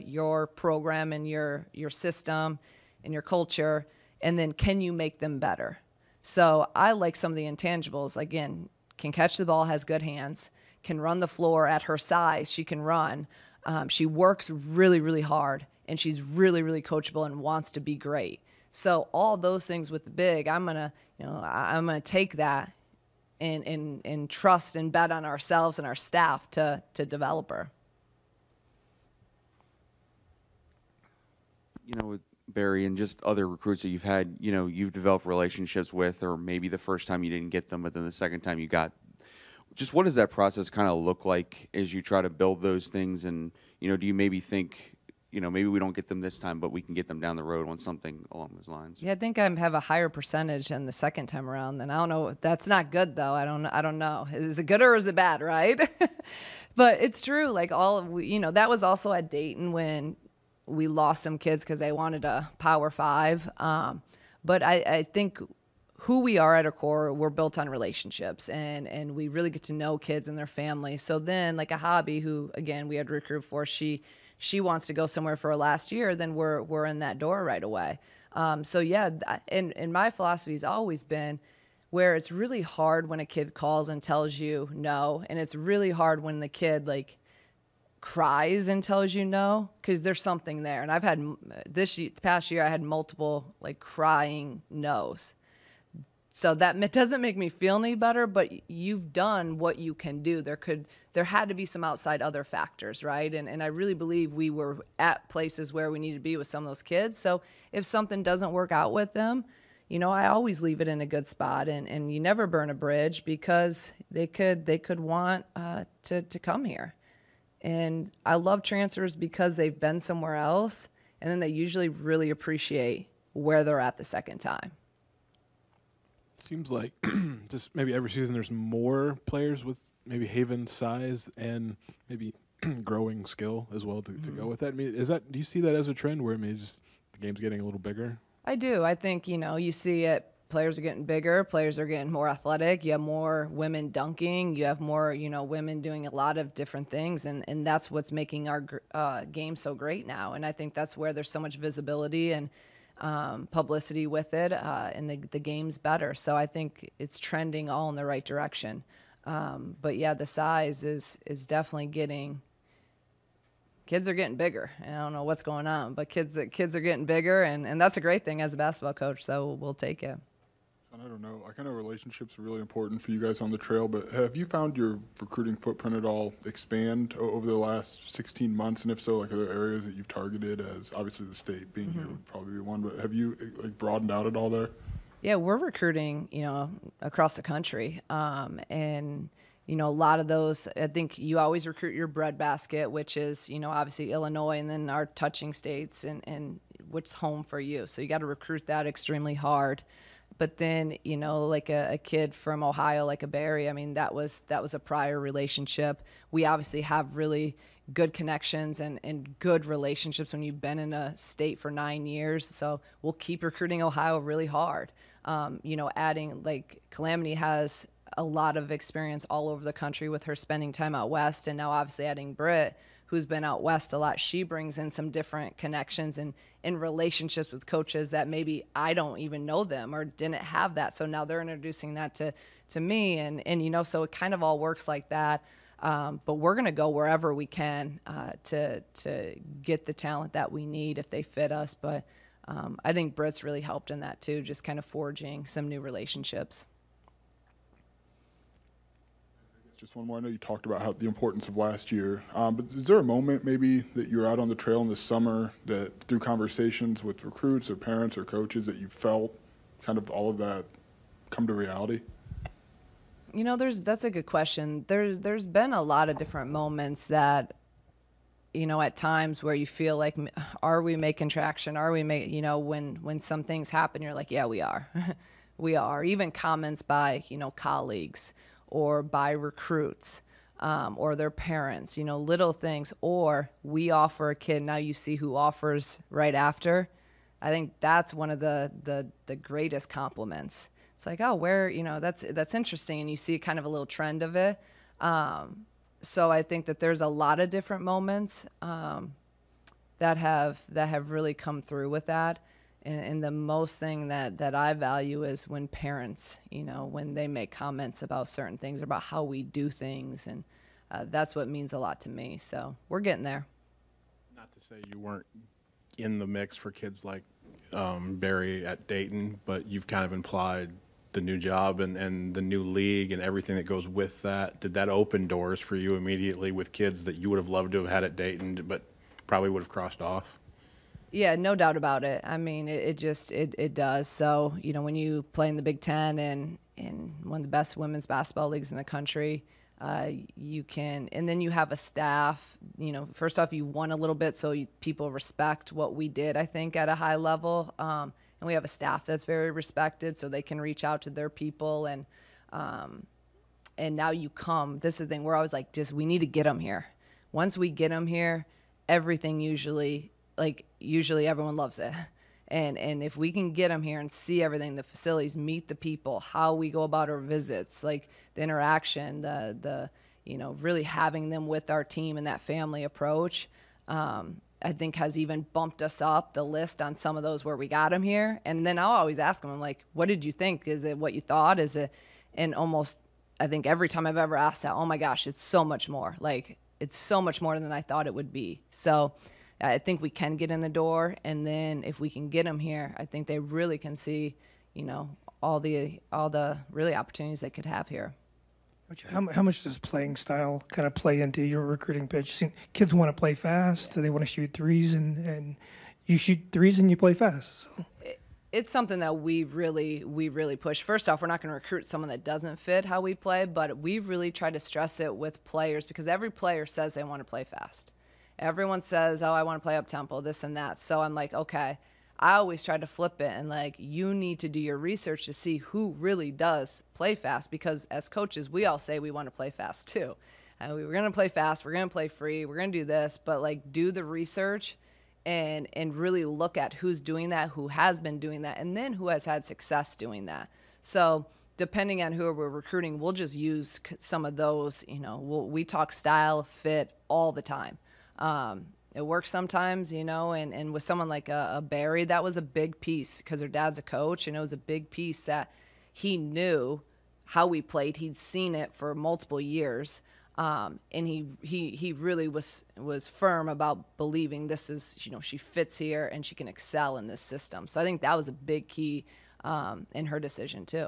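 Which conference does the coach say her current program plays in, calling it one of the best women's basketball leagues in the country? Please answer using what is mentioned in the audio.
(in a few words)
Big Ten.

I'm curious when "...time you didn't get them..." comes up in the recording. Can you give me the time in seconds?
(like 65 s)
37 s.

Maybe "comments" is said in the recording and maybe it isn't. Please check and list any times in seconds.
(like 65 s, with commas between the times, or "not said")
276 s, 307 s.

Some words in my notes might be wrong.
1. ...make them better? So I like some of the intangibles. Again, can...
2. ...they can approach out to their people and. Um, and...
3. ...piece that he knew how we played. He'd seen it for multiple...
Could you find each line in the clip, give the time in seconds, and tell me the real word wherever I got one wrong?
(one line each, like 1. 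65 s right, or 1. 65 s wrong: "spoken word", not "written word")
1. 4 s right
2. 350 s wrong: "reach", not "approach"
3. 454 s right.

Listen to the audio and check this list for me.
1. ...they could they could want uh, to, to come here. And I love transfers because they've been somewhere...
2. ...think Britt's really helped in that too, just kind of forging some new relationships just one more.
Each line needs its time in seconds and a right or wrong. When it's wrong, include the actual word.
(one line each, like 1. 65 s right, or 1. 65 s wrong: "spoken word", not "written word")
1. 114 s right
2. 242 s right.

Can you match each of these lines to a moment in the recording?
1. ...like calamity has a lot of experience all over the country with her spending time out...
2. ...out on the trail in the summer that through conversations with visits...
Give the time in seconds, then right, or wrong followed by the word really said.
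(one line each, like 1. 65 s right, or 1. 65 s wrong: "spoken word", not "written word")
1. 216 s right
2. 254 s wrong: "recruits", not "visits".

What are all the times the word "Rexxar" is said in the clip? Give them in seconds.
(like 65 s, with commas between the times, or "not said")
not said.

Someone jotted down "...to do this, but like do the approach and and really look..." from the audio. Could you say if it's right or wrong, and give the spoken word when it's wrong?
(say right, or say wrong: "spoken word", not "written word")
wrong: "research", not "approach".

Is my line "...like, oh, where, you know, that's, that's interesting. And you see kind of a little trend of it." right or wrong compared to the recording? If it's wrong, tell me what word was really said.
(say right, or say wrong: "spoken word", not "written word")
right.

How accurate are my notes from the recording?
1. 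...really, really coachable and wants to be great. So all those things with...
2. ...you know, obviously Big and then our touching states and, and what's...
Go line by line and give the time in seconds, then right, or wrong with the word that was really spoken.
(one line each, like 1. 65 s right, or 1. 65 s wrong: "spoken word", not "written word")
1. 16 s right
2. 193 s wrong: "Illinois", not "Big".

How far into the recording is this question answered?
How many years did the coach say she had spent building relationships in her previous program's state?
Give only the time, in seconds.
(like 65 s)
211 s.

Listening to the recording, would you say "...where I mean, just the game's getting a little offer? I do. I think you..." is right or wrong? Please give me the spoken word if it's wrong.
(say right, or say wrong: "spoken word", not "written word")
wrong: "bigger", not "offer".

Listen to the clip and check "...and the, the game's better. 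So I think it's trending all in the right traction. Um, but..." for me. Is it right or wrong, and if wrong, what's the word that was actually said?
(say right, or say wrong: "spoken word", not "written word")
wrong: "direction", not "traction".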